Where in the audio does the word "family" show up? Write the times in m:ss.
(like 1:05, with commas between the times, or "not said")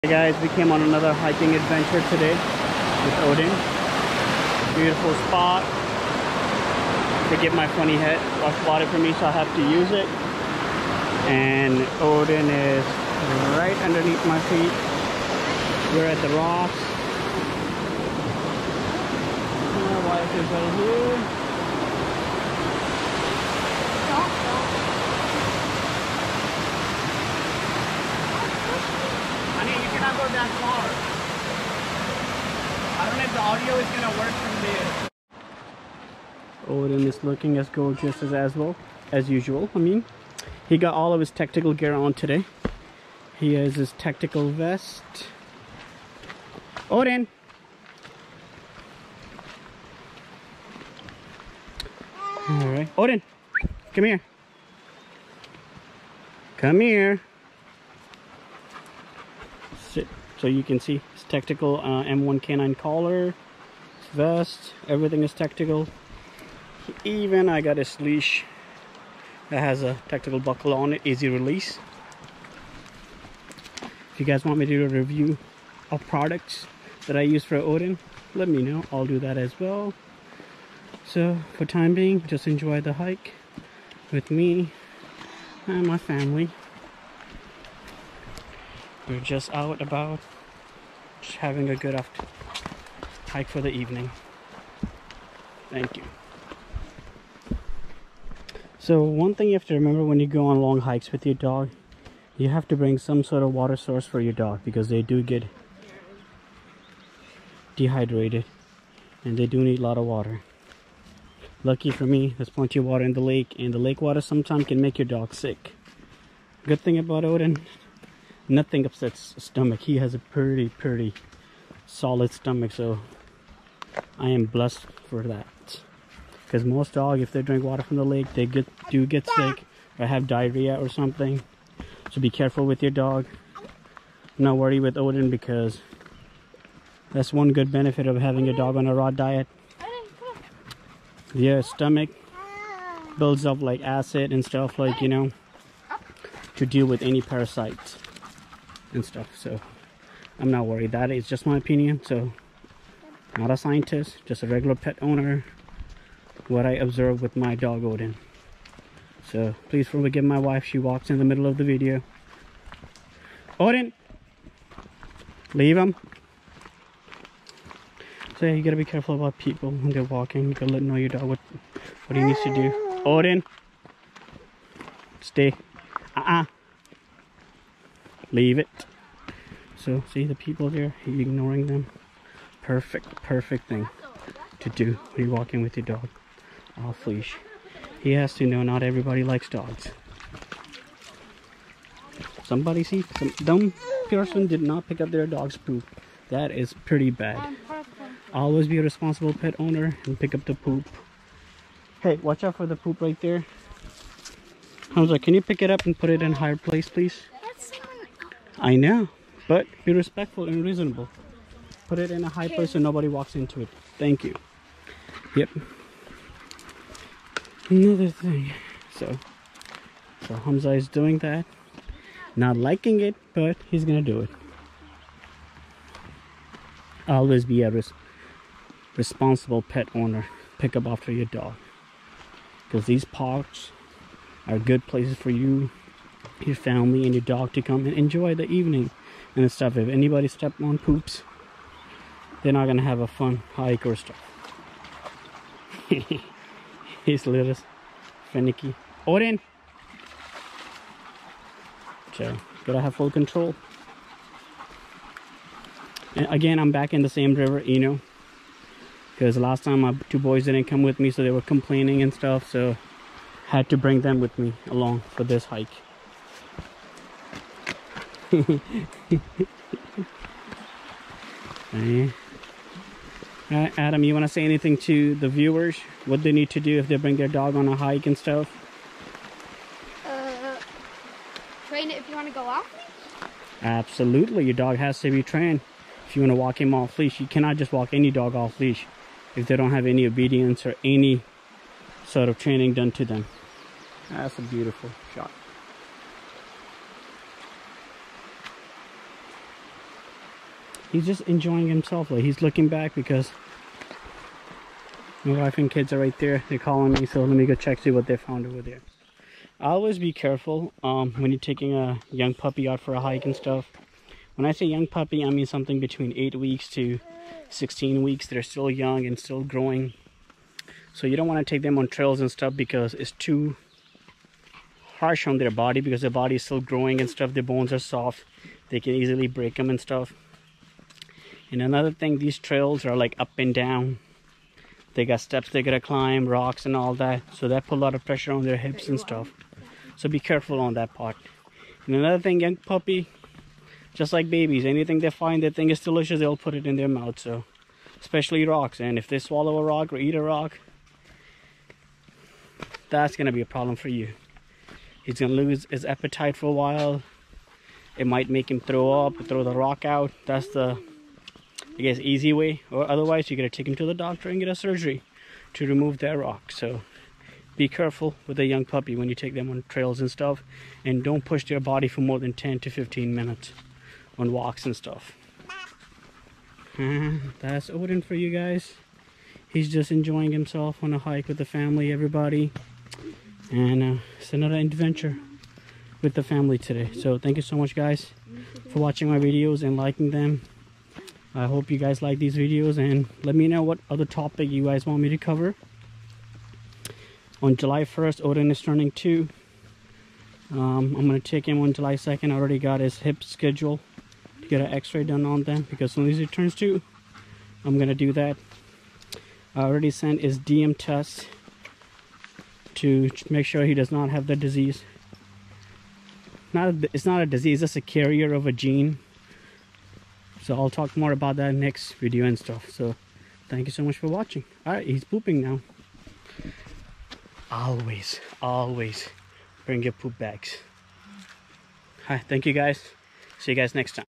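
1:25, 3:56, 6:21, 6:26.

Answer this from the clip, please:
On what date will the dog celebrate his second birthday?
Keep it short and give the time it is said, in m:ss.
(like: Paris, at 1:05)
July 1st, at 6:37.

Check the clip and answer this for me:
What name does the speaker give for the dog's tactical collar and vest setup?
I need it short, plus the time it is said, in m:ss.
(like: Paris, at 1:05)
M1, at 1:02.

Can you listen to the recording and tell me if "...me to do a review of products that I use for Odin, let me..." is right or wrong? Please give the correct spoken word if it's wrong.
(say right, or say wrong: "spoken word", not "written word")
right.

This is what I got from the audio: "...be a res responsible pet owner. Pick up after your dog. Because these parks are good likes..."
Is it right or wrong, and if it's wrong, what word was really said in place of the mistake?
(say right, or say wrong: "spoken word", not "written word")
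wrong: "places", not "likes".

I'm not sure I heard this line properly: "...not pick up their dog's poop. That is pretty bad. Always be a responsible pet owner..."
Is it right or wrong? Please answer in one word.
right.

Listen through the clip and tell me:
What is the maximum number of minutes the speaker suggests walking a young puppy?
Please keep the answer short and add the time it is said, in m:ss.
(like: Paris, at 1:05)
15, at 6:12.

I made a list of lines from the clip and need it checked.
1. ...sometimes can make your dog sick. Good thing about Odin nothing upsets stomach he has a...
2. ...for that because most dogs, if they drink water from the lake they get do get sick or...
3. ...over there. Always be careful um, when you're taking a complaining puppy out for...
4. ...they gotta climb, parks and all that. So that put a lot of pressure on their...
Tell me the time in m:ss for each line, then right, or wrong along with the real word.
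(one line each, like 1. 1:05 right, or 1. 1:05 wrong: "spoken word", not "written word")
1. 1:54 right
2. 2:05 right
3. 5:08 wrong: "young", not "complaining"
4. 5:35 wrong: "rocks", not "parks".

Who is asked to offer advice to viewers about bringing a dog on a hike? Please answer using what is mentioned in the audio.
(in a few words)
Adam.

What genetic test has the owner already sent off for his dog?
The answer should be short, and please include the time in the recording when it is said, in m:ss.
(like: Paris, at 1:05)
DM test, at 6:50.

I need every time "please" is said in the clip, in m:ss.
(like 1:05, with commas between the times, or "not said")
2:39, 3:26.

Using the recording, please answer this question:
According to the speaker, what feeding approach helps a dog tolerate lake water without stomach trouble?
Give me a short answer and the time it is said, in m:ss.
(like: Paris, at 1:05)
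raw diet, at 2:18.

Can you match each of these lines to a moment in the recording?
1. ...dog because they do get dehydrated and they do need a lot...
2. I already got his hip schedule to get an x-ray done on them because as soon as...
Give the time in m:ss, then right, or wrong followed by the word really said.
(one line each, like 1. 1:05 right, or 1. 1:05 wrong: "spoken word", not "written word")
1. 1:44 right
2. 6:42 right.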